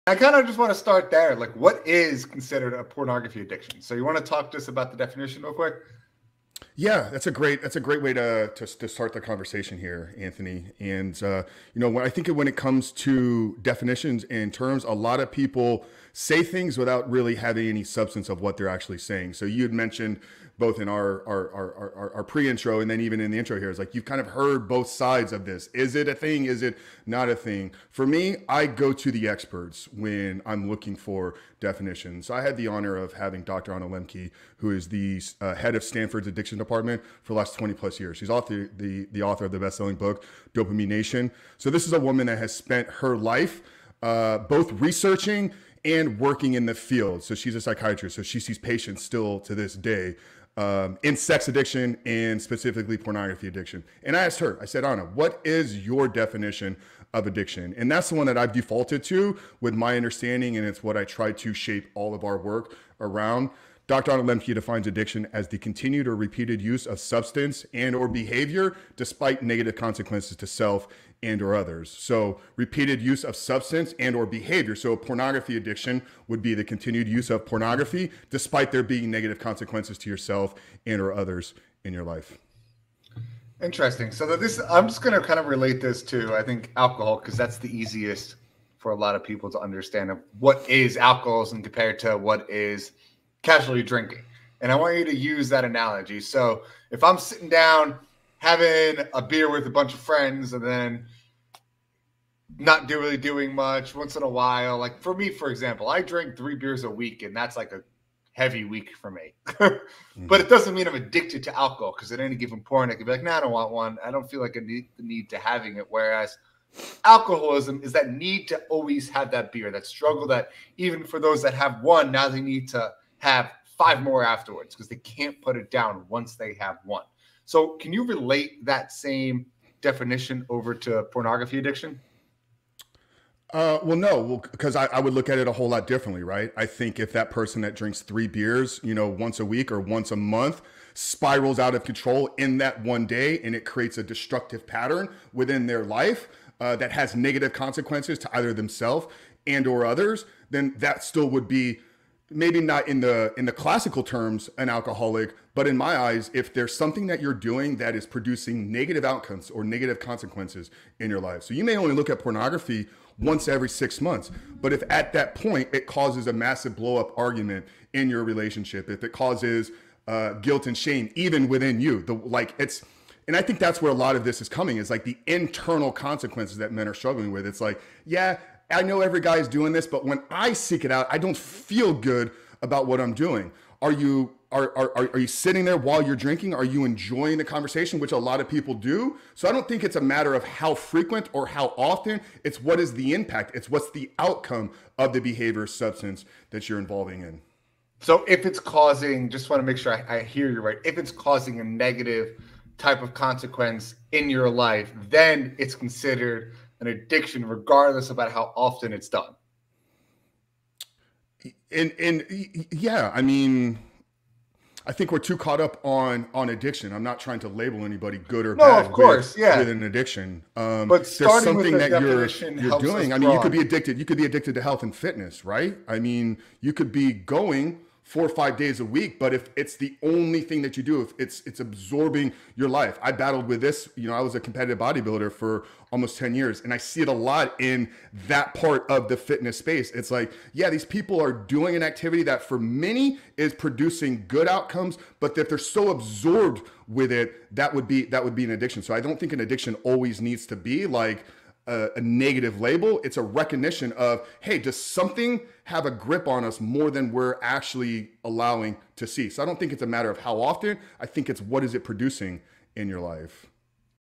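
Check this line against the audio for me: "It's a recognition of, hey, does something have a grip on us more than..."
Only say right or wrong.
right.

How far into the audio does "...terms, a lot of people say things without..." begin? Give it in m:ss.
0:14.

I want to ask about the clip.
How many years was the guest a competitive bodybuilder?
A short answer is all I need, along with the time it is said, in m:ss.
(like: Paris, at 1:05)
almost 10 years, at 3:55.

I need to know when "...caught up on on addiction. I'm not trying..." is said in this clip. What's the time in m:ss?
3:35.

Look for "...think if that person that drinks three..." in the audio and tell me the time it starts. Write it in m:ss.
2:16.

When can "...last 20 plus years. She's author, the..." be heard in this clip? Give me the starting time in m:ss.
0:37.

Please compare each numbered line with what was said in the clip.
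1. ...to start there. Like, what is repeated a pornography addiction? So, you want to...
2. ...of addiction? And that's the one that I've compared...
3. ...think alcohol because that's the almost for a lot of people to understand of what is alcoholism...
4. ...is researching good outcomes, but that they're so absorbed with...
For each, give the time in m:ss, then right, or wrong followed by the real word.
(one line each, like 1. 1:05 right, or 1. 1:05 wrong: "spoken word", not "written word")
1. 0:00 wrong: "considered", not "repeated"
2. 0:57 wrong: "defaulted", not "compared"
3. 1:26 wrong: "easiest", not "almost"
4. 4:03 wrong: "producing", not "researching".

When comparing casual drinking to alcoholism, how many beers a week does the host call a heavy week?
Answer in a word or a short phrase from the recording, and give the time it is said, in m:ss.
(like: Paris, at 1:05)
3, at 1:46.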